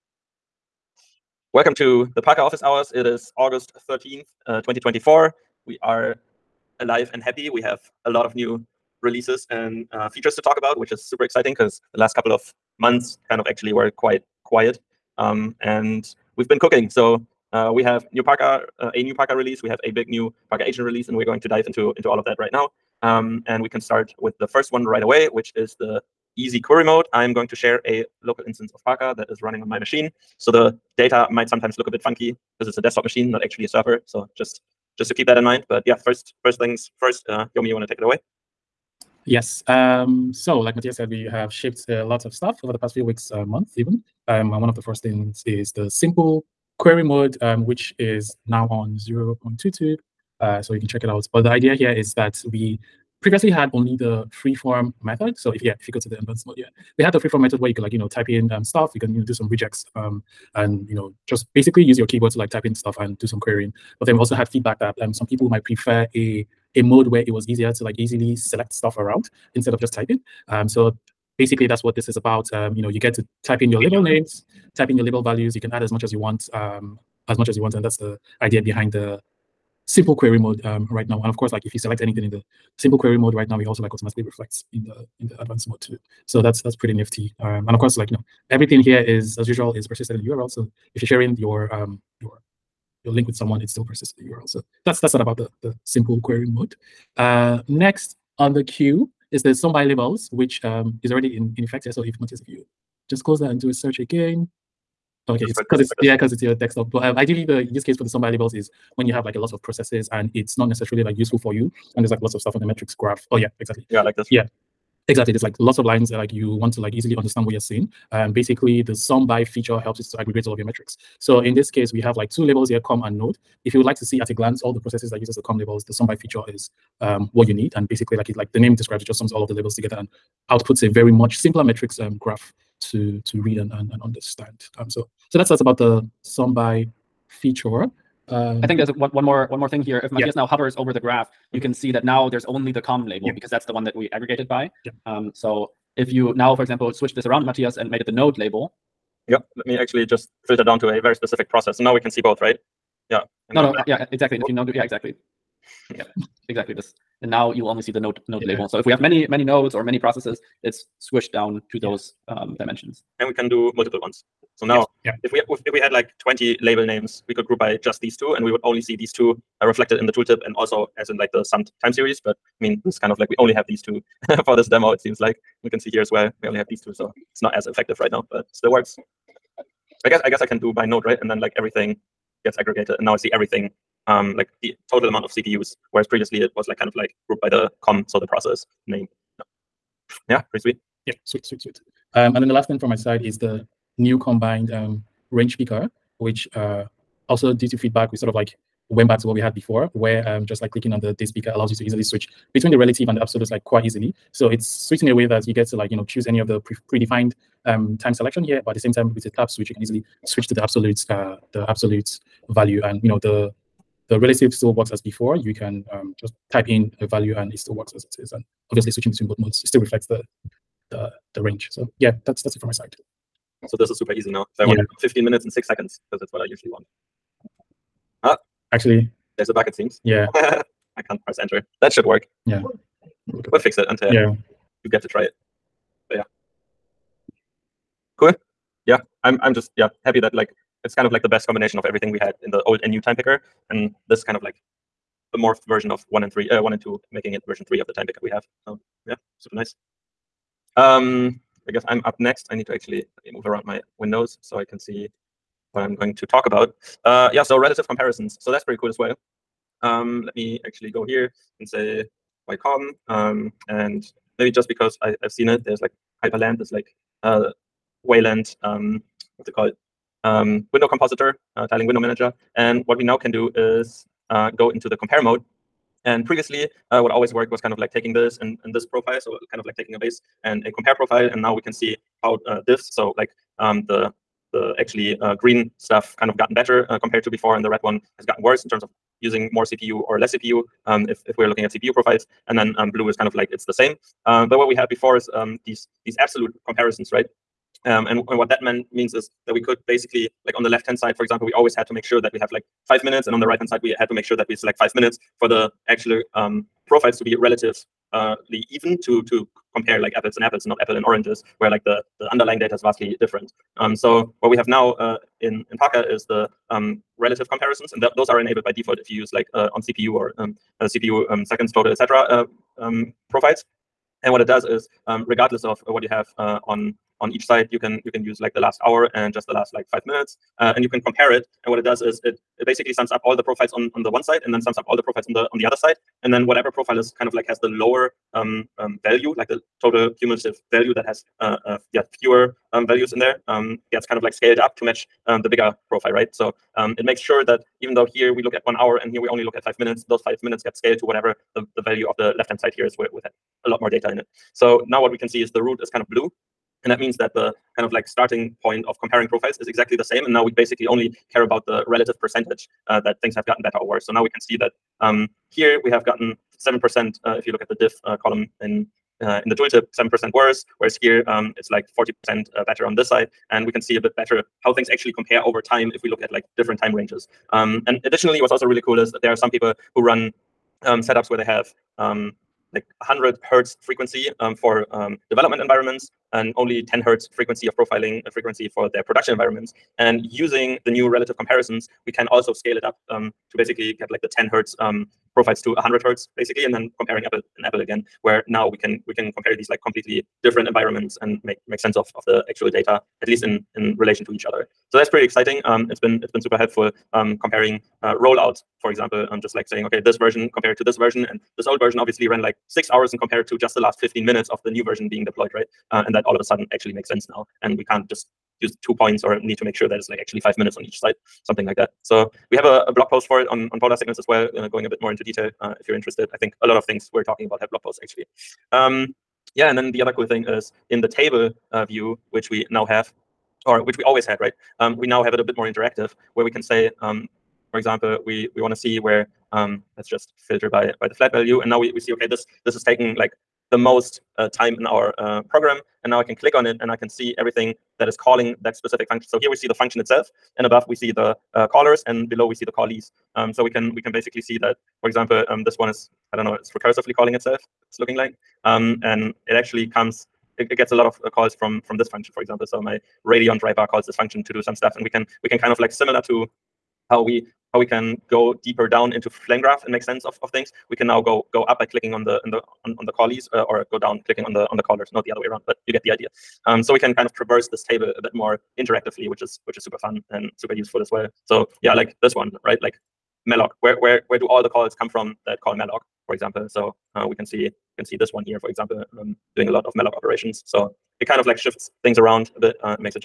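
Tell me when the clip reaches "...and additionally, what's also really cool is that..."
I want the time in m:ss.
6:17.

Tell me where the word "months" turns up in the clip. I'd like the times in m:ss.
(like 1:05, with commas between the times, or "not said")
0:12, 0:43.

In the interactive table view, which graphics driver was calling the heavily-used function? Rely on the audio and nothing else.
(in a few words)
radeon.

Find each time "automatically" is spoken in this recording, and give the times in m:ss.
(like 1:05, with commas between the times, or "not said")
1:23.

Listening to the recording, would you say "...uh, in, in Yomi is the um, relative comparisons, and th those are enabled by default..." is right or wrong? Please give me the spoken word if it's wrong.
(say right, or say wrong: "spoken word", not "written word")
wrong: "Parca", not "Yomi".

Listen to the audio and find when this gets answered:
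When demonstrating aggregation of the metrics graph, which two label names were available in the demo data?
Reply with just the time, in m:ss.
2:02.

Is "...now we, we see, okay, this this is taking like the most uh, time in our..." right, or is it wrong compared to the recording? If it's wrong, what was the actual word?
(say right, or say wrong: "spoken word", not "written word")
right.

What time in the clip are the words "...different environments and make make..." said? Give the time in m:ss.
6:40.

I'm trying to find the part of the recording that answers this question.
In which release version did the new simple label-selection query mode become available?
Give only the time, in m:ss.
0:48.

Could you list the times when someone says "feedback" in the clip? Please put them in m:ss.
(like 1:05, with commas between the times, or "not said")
1:04, 3:17.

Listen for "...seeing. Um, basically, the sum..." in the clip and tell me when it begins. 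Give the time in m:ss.
1:57.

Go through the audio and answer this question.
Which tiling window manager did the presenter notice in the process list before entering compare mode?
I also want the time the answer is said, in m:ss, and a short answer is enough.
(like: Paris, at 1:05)
Hyprland, at 4:26.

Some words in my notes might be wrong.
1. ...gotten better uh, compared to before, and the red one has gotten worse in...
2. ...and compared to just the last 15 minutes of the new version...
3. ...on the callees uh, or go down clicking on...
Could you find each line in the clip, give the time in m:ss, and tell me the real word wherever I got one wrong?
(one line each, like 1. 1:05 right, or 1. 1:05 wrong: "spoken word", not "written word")
1. 4:46 right
2. 6:53 right
3. 7:52 right.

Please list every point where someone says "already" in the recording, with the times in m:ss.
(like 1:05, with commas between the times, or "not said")
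1:41.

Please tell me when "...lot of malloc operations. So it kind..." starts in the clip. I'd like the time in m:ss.
8:09.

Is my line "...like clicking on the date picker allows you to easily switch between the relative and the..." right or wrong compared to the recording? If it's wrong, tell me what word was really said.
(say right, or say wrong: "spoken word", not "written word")
right.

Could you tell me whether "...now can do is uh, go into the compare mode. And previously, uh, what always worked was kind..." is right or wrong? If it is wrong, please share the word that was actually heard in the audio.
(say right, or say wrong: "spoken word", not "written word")
right.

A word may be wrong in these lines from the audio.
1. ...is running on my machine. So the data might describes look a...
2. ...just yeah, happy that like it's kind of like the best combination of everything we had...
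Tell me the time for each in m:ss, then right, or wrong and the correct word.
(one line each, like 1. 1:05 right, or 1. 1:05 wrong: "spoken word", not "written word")
1. 0:29 wrong: "sometimes", not "describes"
2. 3:59 right.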